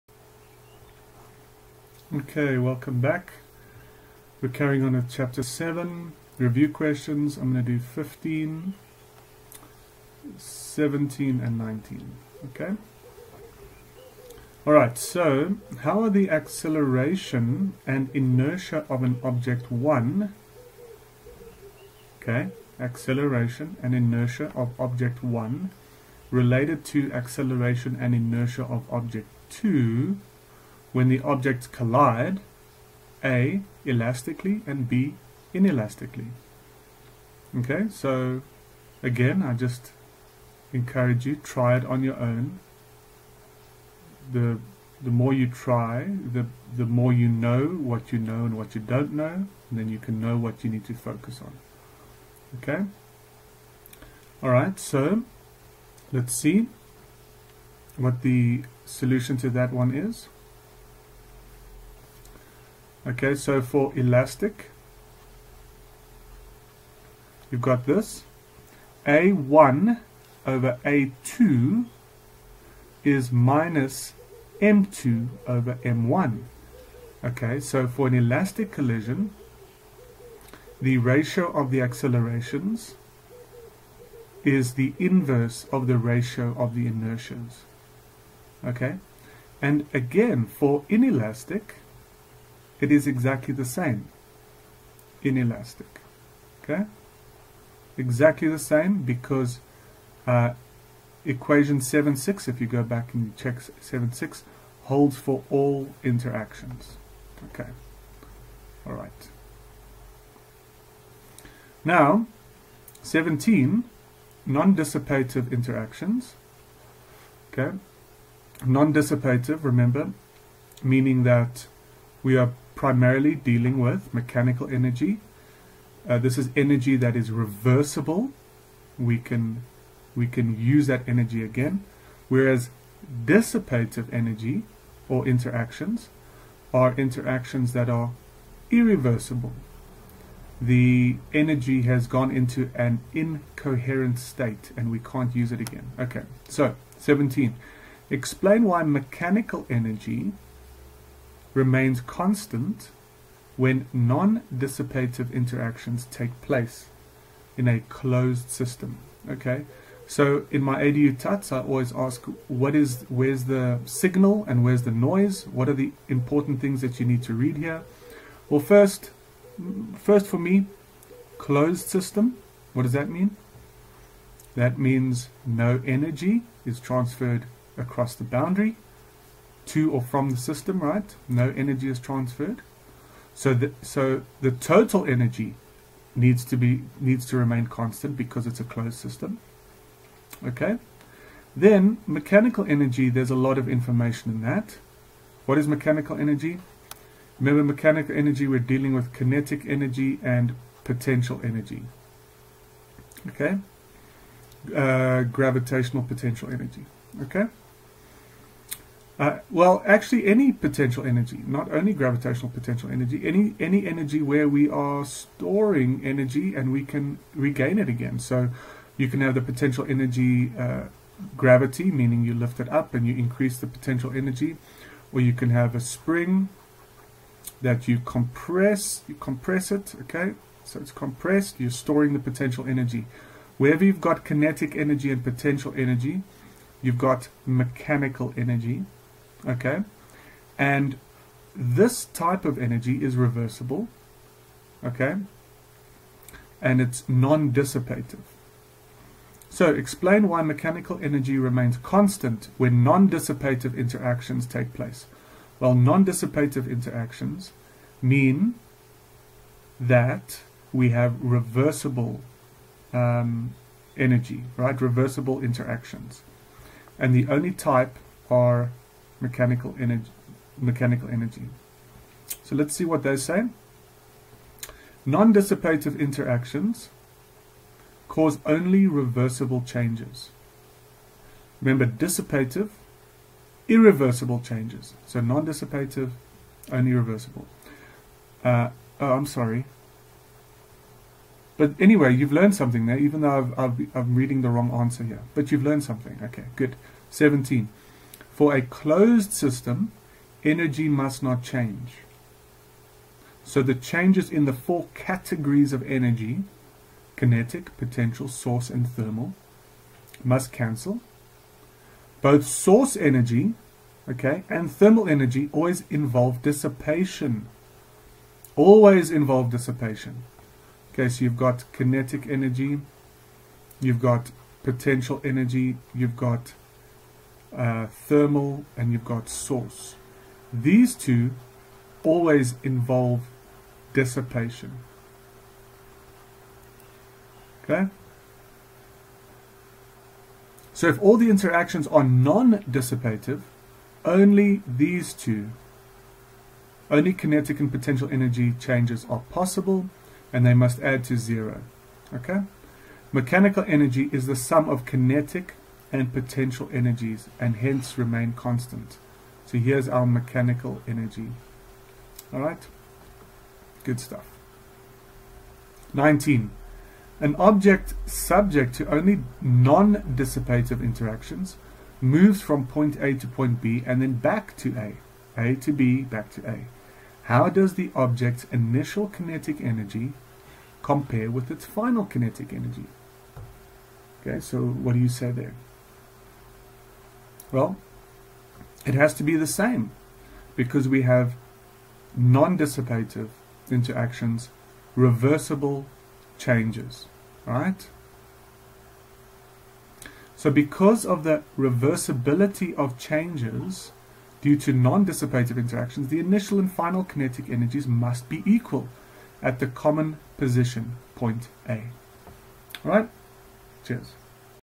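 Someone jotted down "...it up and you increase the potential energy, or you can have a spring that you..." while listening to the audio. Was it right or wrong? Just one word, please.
right.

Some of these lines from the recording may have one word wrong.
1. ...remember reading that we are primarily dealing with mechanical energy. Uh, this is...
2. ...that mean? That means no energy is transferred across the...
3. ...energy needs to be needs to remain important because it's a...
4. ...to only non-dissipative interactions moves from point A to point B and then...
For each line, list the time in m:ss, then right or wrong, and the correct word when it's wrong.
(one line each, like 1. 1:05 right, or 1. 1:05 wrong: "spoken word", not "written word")
1. 1:59 wrong: "meaning", not "reading"
2. 2:52 right
3. 3:05 wrong: "constant", not "important"
4. 6:08 right.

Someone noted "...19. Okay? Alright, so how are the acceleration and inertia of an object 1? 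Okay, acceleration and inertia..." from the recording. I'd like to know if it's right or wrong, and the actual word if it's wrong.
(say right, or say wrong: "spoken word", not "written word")
right.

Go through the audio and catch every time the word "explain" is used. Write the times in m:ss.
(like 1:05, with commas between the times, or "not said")
2:28, 4:09.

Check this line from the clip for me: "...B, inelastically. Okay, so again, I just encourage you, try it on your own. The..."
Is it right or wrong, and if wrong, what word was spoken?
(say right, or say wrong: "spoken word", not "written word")
right.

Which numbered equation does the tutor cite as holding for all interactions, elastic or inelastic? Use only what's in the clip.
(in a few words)
7.6.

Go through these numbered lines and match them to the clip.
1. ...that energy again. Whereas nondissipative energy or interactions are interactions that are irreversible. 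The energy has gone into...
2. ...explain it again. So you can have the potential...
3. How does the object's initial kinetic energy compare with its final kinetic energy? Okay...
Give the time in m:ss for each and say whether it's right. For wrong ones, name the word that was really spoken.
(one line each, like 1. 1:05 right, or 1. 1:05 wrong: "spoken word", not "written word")
1. 2:10 wrong: "dissipative", not "nondissipative"
2. 3:37 wrong: "regain", not "explain"
3. 6:17 right.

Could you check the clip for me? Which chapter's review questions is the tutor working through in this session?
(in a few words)
7.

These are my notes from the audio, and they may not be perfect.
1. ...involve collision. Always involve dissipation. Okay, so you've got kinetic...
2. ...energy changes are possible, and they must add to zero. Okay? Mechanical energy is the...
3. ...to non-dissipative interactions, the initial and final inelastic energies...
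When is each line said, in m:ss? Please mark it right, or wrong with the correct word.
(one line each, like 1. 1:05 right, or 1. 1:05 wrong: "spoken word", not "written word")
1. 5:15 wrong: "dissipation", not "collision"
2. 5:48 right
3. 6:44 wrong: "kinetic", not "inelastic".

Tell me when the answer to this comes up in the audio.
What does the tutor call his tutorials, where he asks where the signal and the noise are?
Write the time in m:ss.
2:40.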